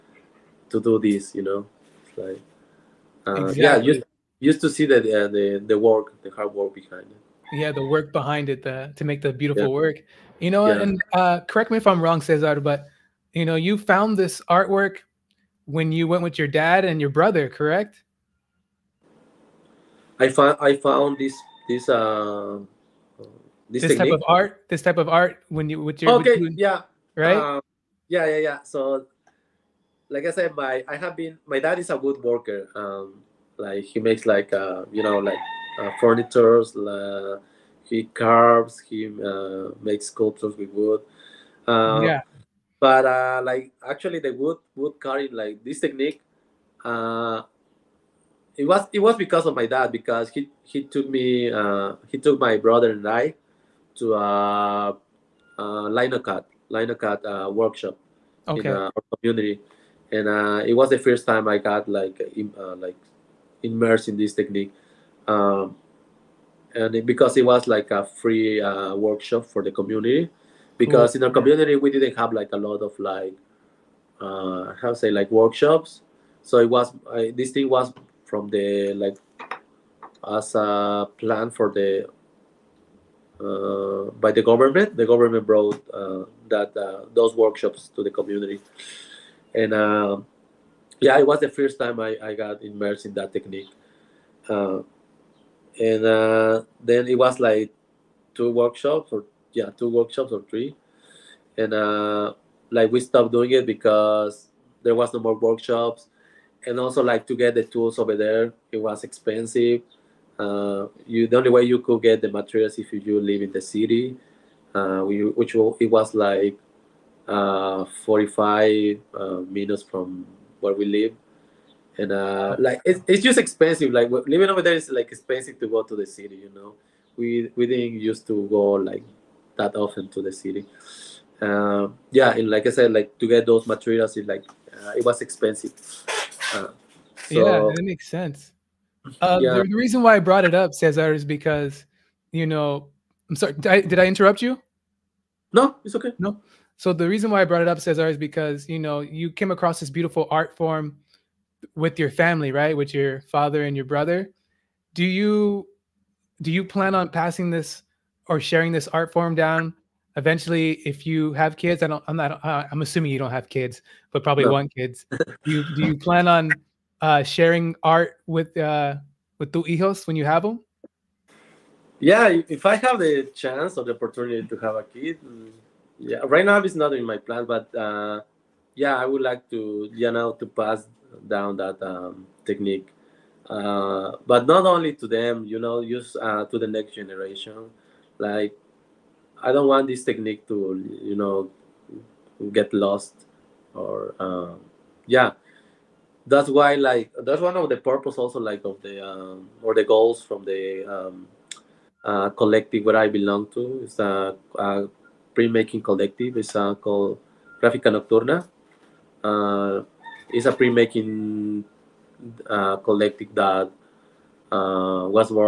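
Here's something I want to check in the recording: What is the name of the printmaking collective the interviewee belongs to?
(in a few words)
Gráfica Nocturna.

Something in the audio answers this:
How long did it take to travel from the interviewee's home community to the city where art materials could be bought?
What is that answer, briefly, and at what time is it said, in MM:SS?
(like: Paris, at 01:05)
45 minutes, at 01:58.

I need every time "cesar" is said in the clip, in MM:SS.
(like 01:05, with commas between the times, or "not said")
00:12, 02:20, 02:27.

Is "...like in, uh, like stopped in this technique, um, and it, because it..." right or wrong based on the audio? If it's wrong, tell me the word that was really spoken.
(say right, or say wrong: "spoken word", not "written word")
wrong: "immersed", not "stopped".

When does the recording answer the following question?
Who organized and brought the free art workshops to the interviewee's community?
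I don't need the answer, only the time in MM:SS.
01:24.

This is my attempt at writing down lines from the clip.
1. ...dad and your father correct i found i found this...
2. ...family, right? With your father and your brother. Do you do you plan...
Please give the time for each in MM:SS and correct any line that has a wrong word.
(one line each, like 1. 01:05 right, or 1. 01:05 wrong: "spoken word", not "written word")
1. 00:16 wrong: "brother", not "father"
2. 02:32 right.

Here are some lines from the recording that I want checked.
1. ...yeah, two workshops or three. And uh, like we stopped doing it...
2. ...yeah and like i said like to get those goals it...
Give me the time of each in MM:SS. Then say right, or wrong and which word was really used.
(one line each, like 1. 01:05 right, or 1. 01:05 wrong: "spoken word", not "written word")
1. 01:39 right
2. 02:12 wrong: "materials", not "goals".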